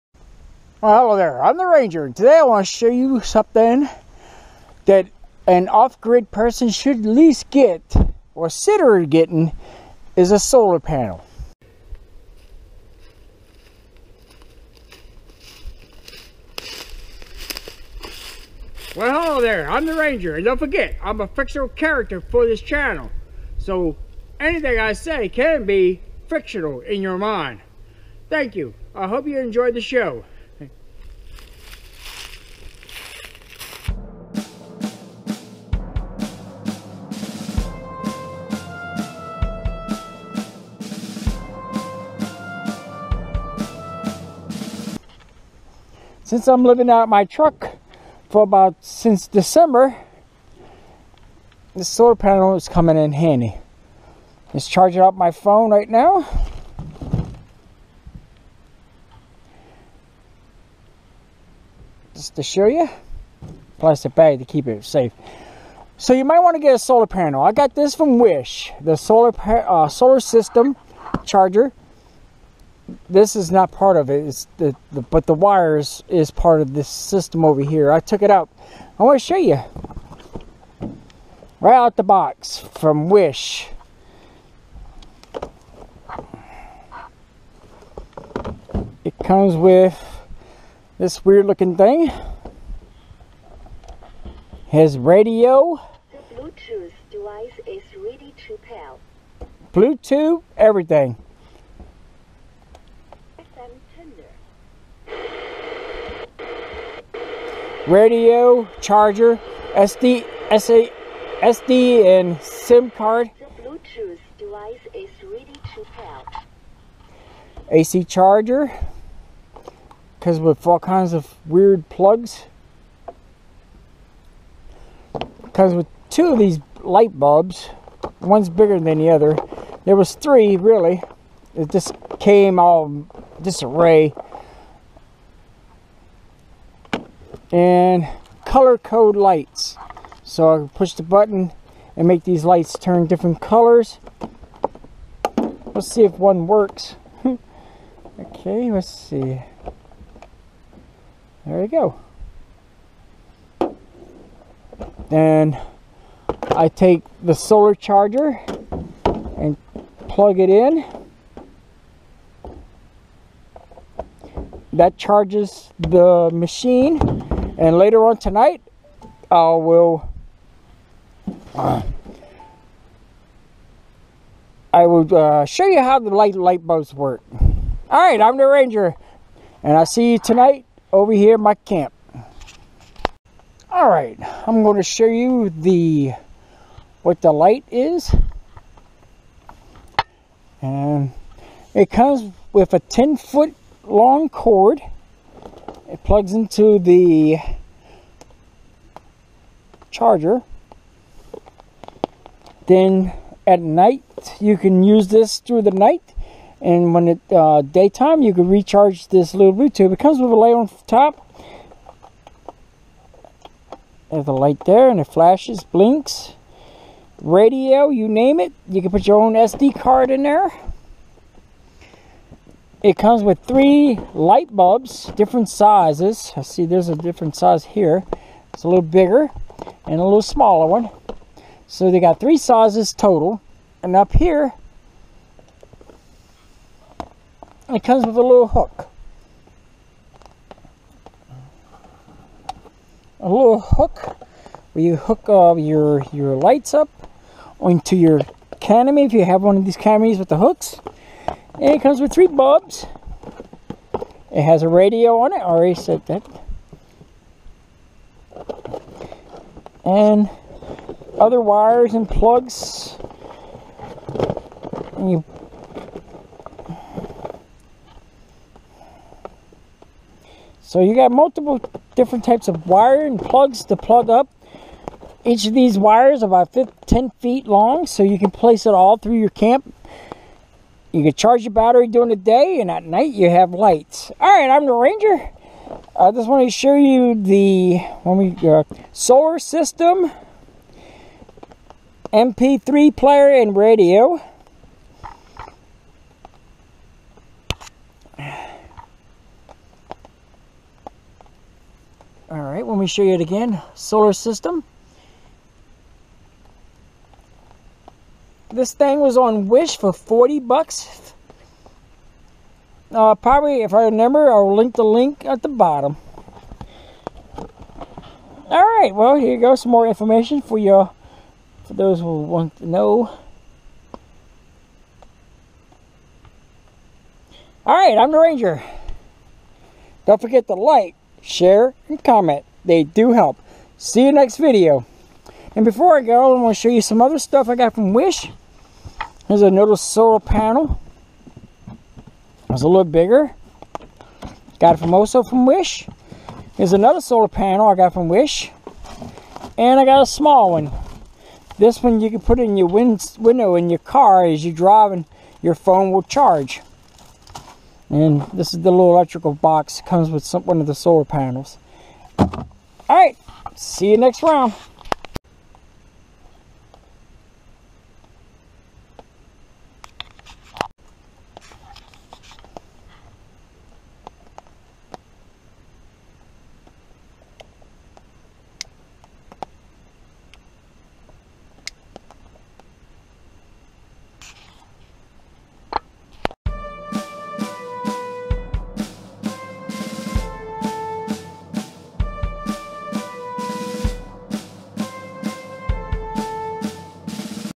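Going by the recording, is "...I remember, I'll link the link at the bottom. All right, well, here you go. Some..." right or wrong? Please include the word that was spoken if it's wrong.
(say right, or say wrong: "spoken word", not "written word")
right.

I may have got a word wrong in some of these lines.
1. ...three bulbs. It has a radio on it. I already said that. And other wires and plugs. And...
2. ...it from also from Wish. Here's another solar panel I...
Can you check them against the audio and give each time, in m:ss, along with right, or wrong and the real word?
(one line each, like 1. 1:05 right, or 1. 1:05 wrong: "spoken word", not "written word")
1. 4:12 right
2. 5:44 right.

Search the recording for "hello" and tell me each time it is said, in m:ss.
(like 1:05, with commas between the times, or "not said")
0:01, 0:19.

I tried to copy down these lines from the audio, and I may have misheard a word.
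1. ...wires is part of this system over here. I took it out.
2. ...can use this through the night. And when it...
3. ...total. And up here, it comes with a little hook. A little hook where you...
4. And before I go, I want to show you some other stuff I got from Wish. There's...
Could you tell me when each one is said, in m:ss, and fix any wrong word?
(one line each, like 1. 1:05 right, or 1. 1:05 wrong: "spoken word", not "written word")
1. 1:15 right
2. 3:24 right
3. 3:52 right
4. 5:35 right.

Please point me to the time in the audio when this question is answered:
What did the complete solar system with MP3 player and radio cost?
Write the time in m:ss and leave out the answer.
5:09.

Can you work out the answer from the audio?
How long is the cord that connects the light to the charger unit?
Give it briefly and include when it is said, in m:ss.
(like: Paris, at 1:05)
10 foot, at 3:12.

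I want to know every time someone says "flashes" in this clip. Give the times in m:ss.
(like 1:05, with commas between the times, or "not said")
3:35.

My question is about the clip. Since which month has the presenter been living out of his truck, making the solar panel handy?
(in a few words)
December.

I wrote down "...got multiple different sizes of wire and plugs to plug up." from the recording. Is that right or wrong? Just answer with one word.
wrong.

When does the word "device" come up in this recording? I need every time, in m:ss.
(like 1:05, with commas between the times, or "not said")
1:37, 1:54.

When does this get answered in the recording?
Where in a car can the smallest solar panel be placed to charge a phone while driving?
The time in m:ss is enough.
5:53.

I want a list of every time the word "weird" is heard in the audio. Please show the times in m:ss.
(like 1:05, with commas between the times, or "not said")
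1:31, 2:01.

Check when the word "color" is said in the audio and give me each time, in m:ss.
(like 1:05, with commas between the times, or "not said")
2:18, 2:23.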